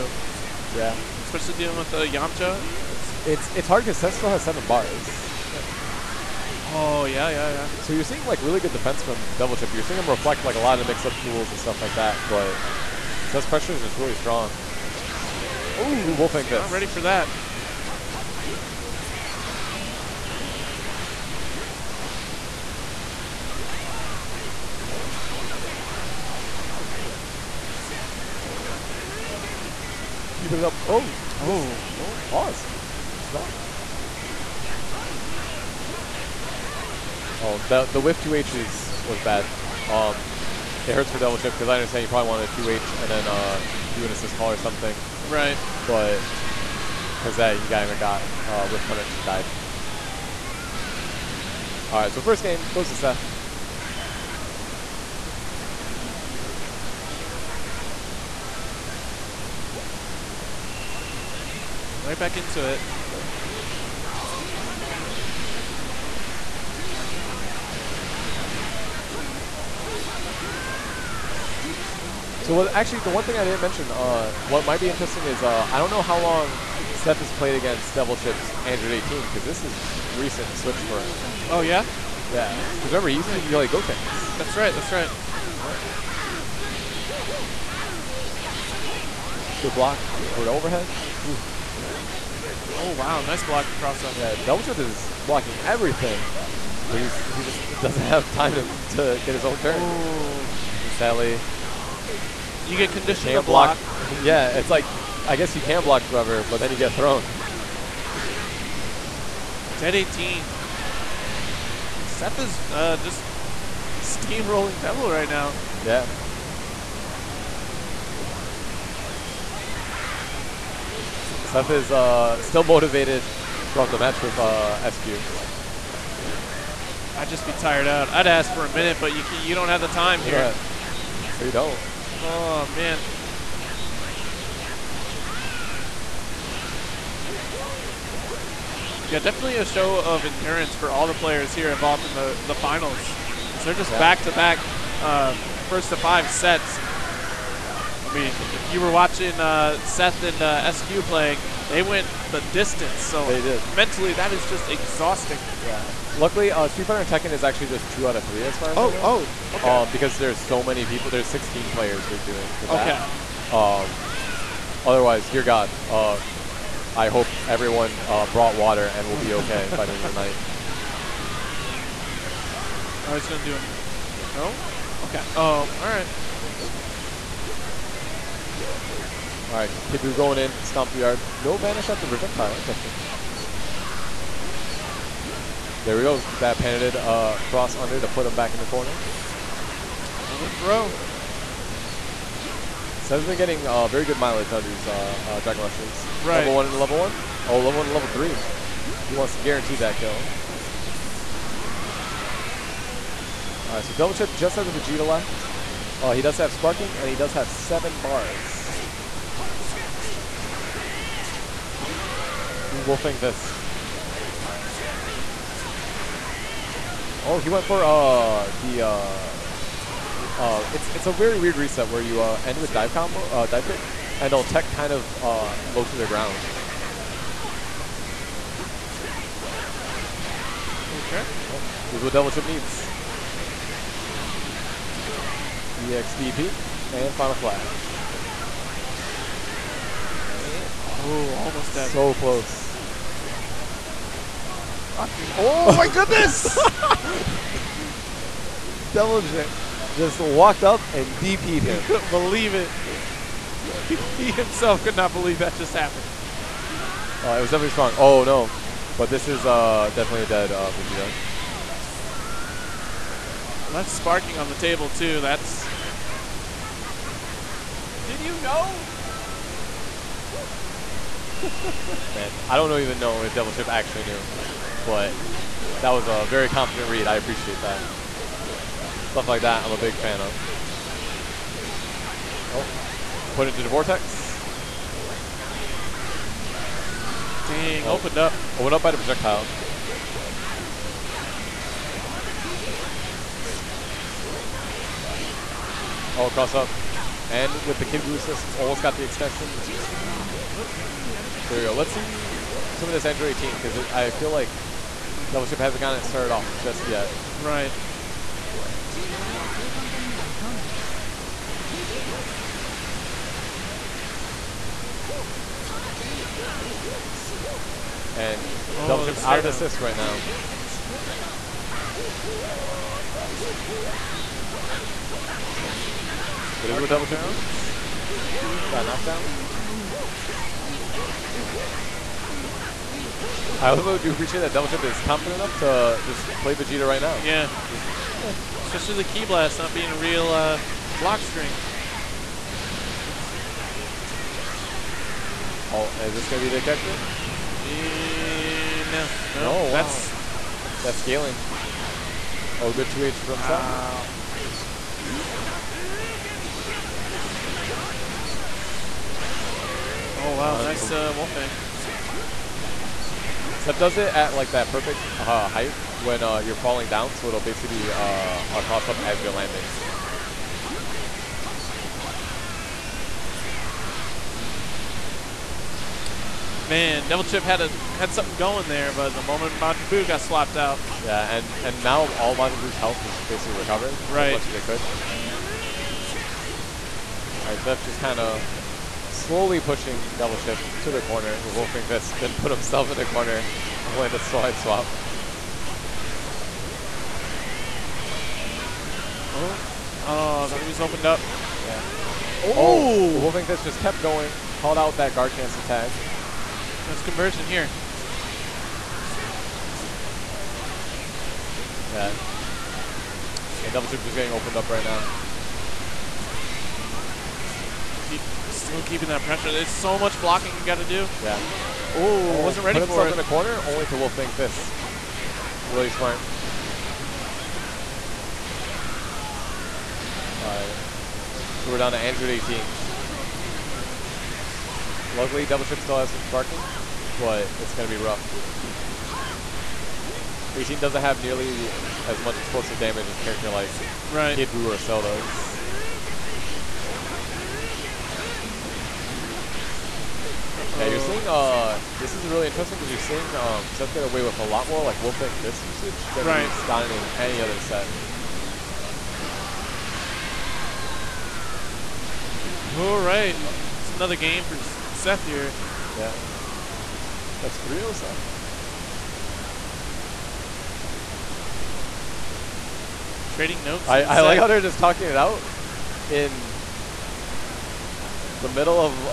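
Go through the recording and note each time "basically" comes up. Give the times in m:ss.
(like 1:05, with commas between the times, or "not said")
6:07, 6:23.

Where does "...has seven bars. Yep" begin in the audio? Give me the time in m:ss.
0:04.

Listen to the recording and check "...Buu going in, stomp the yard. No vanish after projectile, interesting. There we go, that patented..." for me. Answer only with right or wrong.
right.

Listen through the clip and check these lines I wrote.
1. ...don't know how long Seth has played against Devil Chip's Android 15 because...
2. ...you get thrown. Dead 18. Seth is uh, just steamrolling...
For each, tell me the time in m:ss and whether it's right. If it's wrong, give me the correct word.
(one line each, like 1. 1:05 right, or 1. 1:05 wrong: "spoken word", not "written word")
1. 1:15 wrong: "18", not "15"
2. 1:46 right.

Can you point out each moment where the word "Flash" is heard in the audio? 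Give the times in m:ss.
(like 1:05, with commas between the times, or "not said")
3:57.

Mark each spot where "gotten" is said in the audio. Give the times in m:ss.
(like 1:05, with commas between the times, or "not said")
5:05, 7:36.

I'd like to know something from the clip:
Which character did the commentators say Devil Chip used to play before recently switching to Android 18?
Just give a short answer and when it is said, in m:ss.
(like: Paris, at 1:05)
Goten, at 1:23.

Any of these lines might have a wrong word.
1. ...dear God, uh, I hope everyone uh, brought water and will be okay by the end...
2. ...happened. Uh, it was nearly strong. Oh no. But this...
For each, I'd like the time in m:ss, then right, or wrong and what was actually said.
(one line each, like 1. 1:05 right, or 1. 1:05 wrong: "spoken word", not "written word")
1. 2:45 right
2. 4:15 wrong: "definitely", not "nearly".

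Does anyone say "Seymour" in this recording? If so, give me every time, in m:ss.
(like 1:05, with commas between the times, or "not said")
not said.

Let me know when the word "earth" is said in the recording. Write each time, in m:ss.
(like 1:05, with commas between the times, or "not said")
not said.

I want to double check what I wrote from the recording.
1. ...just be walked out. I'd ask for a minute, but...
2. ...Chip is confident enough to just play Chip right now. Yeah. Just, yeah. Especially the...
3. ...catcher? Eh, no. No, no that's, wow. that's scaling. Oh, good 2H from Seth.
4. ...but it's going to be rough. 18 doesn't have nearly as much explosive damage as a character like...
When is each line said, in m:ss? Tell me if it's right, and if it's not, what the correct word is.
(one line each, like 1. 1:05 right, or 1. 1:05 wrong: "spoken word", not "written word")
1. 2:07 wrong: "tired", not "walked"
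2. 5:34 wrong: "Vegeta", not "Chip"
3. 5:46 right
4. 7:17 right.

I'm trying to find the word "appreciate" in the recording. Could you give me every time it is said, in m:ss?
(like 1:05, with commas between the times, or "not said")
4:37, 5:34.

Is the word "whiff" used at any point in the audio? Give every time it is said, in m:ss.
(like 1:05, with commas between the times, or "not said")
0:37, 0:48.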